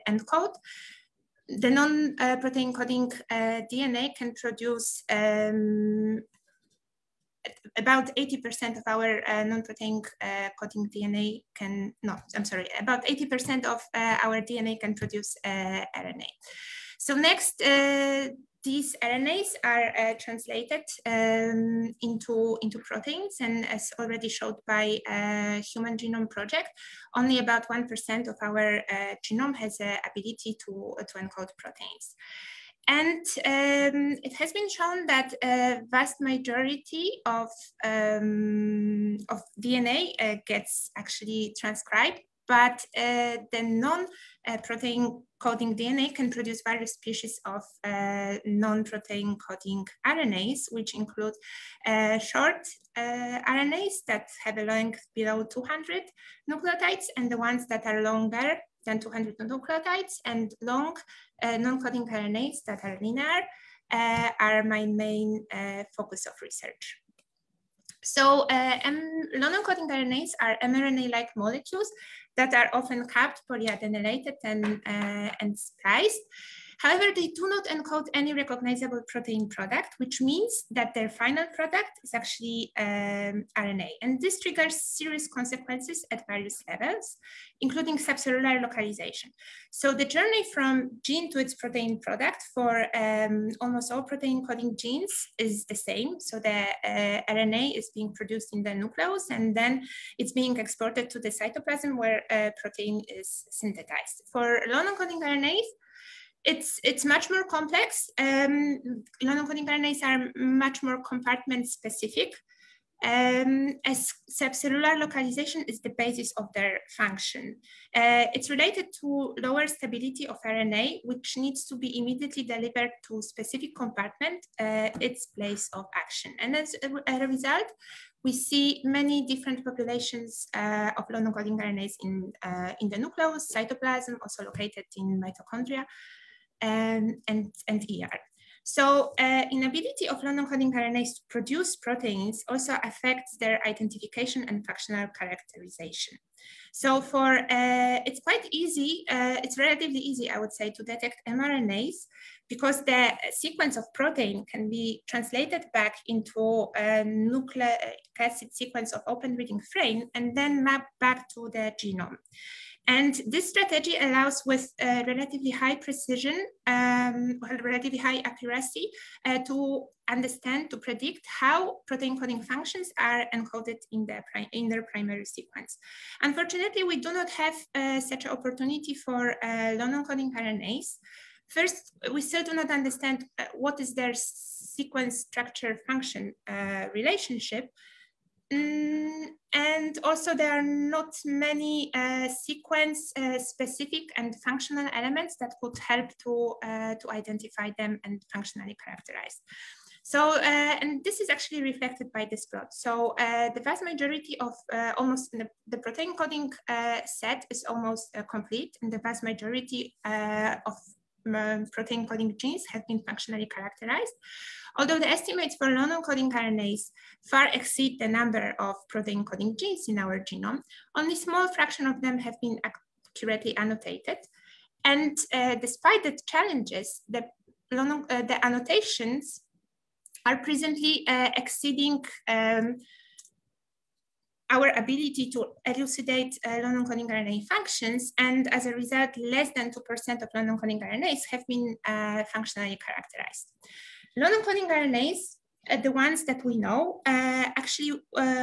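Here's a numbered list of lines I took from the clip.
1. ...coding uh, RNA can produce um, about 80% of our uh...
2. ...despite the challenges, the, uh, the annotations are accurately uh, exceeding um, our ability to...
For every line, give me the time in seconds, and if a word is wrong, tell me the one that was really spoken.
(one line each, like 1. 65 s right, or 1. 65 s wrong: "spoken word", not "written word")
1. 2 s wrong: "DNA", not "RNA"
2. 225 s wrong: "presently", not "accurately".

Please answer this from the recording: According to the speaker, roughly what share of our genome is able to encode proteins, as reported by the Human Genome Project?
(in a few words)
1%.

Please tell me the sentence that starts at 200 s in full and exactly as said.
So, uh, and this is actually reflected by this plot.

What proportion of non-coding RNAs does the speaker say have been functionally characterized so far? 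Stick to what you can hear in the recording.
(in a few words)
less than 2%.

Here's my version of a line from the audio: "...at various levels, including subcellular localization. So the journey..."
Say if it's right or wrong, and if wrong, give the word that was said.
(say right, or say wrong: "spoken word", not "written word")
right.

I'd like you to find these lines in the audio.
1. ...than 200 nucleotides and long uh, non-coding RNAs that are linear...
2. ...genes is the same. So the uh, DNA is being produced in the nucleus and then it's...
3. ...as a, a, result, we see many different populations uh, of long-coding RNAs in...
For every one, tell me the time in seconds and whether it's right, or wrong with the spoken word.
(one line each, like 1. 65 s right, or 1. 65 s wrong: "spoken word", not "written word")
1. 58 s right
2. 94 s wrong: "RNA", not "DNA"
3. 126 s right.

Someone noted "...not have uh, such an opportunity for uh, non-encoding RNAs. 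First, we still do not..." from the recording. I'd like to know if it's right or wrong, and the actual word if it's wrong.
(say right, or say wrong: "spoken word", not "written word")
right.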